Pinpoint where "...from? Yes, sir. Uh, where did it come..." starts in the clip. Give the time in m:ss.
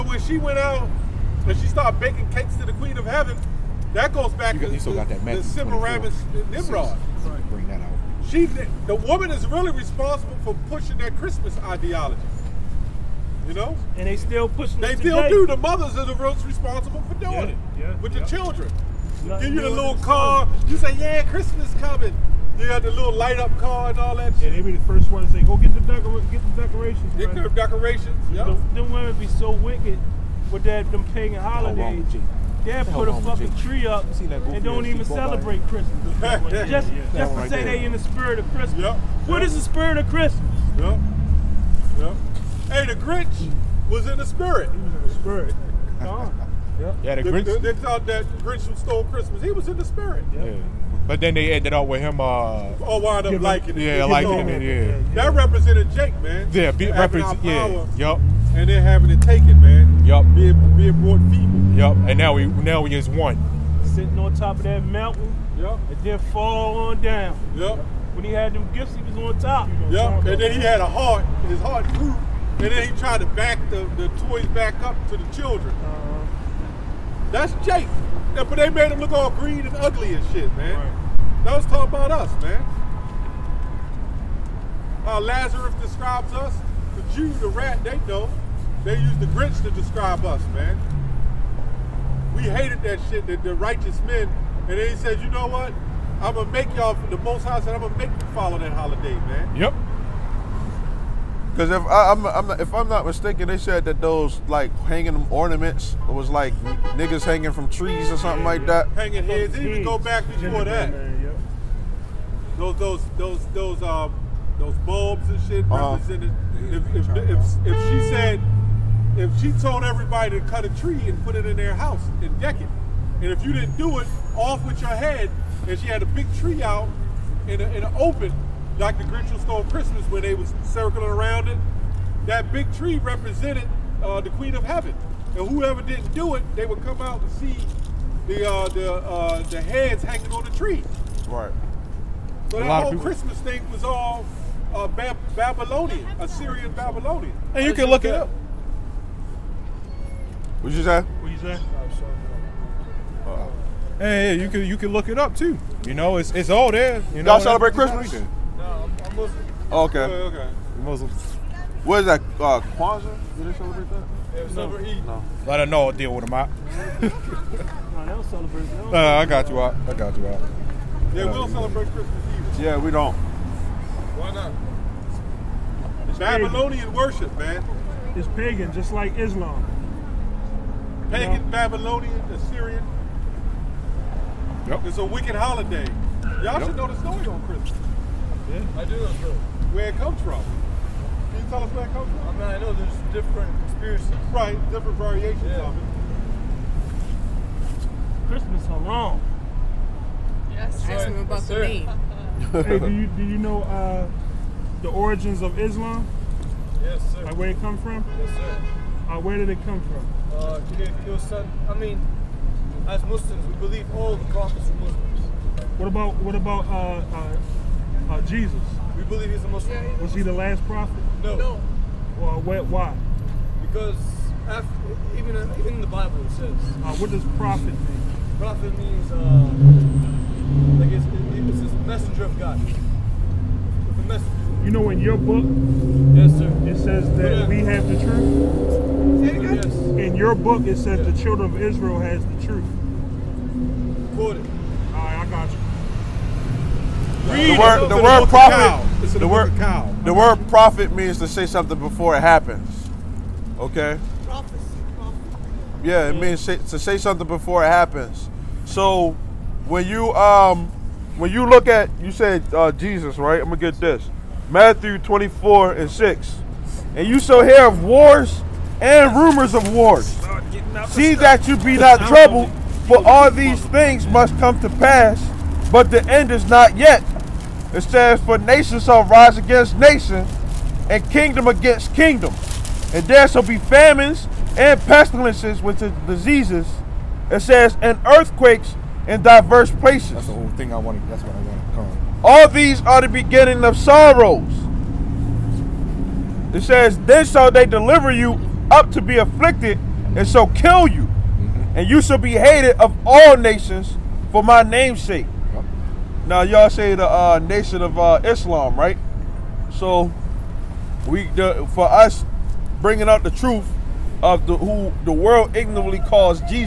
3:27.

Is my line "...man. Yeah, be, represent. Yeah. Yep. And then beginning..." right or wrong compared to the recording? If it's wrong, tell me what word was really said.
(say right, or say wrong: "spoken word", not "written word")
wrong: "having", not "beginning".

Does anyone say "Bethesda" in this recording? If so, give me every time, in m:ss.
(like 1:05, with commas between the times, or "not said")
not said.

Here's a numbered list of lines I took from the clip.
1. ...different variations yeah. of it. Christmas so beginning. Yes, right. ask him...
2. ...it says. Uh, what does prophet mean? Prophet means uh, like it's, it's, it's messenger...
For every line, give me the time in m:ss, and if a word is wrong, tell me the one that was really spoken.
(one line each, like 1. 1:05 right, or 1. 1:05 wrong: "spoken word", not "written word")
1. 3:14 wrong: "wrong", not "beginning"
2. 3:46 right.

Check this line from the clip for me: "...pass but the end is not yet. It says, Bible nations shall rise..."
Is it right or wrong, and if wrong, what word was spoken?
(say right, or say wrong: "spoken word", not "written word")
wrong: "For", not "Bible".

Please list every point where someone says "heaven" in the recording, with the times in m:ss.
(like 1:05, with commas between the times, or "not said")
0:03, 2:14.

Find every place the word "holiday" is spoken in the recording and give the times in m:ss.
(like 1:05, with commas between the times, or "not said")
0:31, 1:38, 3:05.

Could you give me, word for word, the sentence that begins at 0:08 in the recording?
She the woman is really responsible for pushing that Christmas ideology.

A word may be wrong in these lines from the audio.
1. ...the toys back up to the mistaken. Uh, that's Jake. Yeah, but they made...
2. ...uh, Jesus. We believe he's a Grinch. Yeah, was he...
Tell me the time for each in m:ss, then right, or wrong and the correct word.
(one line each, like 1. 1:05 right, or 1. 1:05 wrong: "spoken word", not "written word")
1. 1:13 wrong: "children", not "mistaken"
2. 3:38 wrong: "Muslim", not "Grinch".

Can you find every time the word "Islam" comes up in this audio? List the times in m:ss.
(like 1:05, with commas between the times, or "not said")
2:59, 3:25, 5:08.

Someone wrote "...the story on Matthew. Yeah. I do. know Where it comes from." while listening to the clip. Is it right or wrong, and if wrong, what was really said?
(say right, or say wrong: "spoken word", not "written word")
wrong: "Christmas", not "Matthew".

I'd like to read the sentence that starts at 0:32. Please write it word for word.
Dad put a fucking tree up and don't even celebrate Christmas.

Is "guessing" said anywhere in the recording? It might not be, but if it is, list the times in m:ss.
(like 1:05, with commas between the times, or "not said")
not said.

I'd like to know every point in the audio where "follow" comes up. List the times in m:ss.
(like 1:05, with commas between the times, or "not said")
1:38.